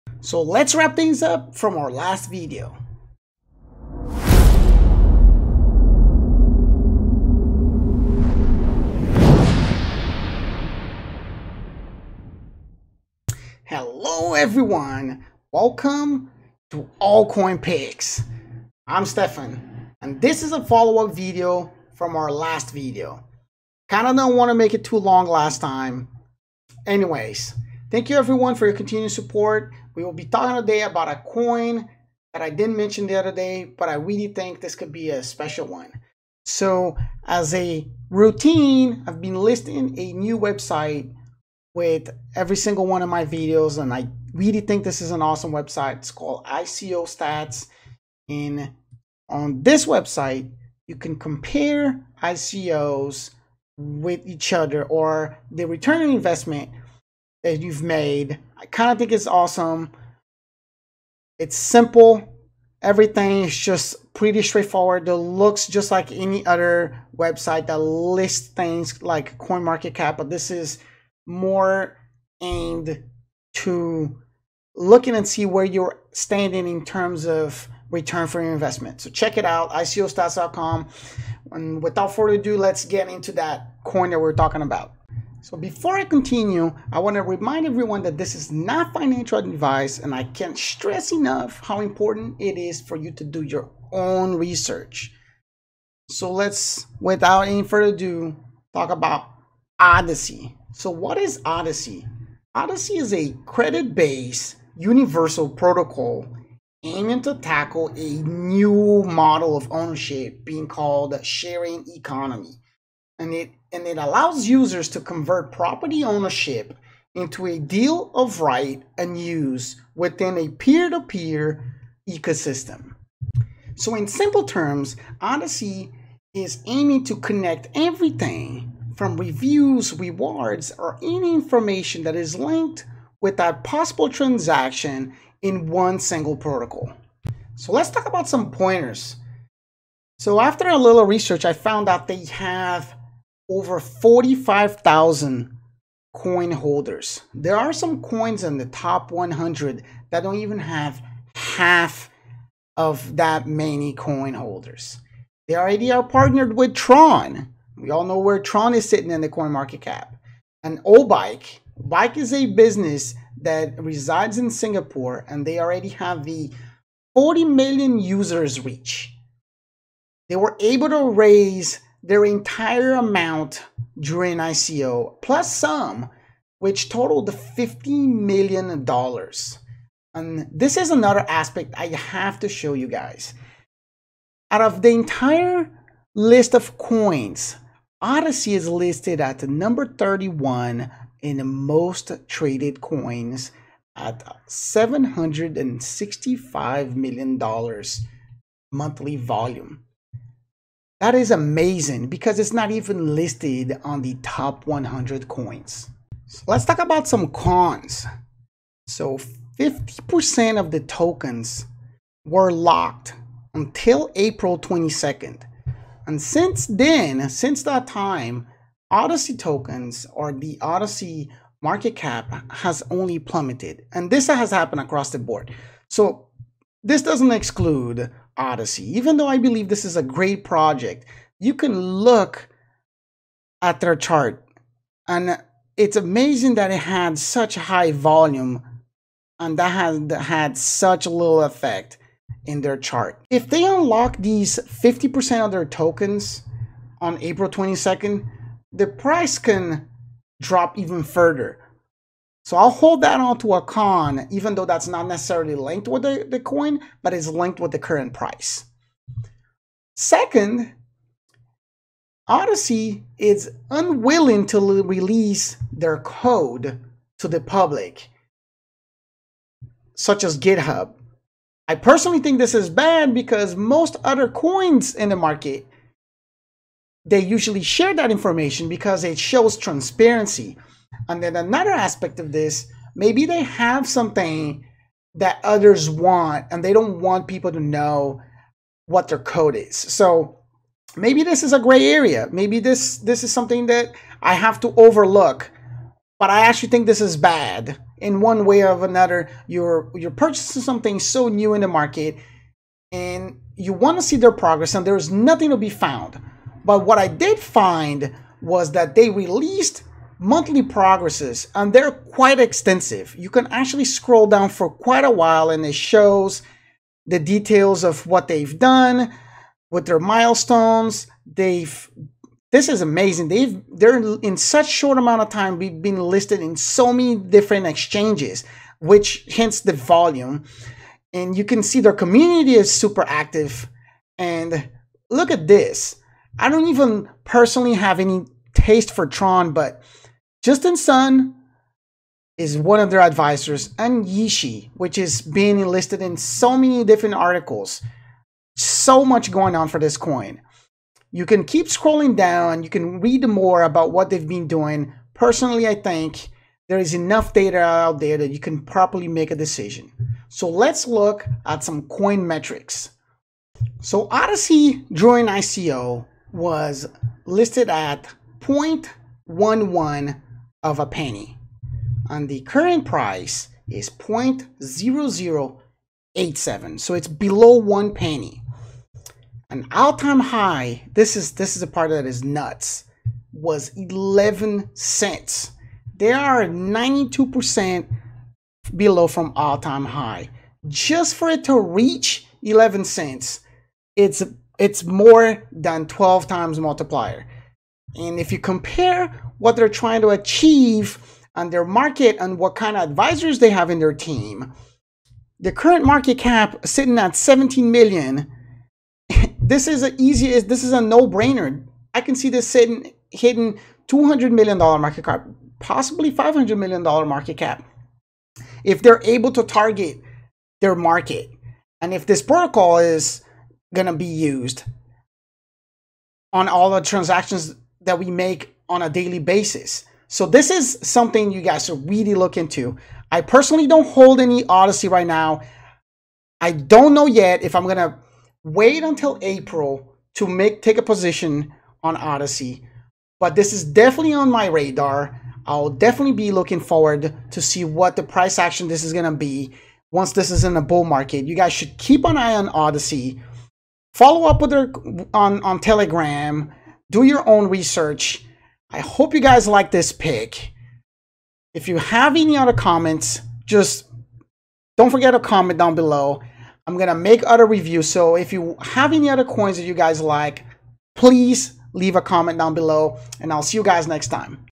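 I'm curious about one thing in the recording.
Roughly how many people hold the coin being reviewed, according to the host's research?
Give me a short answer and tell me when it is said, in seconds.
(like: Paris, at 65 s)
45,000, at 143 s.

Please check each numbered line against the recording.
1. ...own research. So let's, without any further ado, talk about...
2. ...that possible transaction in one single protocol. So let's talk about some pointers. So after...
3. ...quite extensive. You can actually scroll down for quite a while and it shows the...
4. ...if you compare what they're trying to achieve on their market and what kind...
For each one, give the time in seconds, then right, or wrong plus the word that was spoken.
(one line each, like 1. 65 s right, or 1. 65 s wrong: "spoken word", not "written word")
1. 93 s right
2. 133 s right
3. 311 s right
4. 398 s right.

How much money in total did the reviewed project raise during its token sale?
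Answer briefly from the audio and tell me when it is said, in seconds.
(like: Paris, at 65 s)
$50 million, at 177 s.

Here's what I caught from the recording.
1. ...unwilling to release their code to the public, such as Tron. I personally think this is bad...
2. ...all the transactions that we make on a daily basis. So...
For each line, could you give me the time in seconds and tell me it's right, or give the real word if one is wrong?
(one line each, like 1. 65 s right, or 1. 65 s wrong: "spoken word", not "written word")
1. 263 s wrong: "GitHub", not "Tron"
2. 426 s right.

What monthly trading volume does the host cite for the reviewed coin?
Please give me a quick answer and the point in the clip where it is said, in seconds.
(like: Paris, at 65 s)
$765 million, at 194 s.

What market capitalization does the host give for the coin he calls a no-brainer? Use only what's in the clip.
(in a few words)
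17 million.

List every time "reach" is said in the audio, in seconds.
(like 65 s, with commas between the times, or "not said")
168 s, 391 s.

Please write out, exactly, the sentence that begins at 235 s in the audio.
And it's amazing that it had such high volume and that had, had such little effect in their chart.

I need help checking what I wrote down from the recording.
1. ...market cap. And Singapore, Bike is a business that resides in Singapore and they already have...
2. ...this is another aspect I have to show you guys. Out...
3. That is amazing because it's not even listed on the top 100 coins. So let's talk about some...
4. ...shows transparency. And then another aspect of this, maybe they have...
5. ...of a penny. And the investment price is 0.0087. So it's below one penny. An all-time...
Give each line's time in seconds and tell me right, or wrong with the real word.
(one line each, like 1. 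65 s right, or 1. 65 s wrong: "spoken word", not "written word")
1. 159 s wrong: "Obike", not "Singapore"
2. 180 s right
3. 201 s right
4. 279 s right
5. 370 s wrong: "current", not "investment".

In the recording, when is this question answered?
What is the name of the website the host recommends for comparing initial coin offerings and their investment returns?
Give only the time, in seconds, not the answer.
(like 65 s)
46 s.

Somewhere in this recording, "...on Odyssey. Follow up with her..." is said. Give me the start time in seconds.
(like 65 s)
452 s.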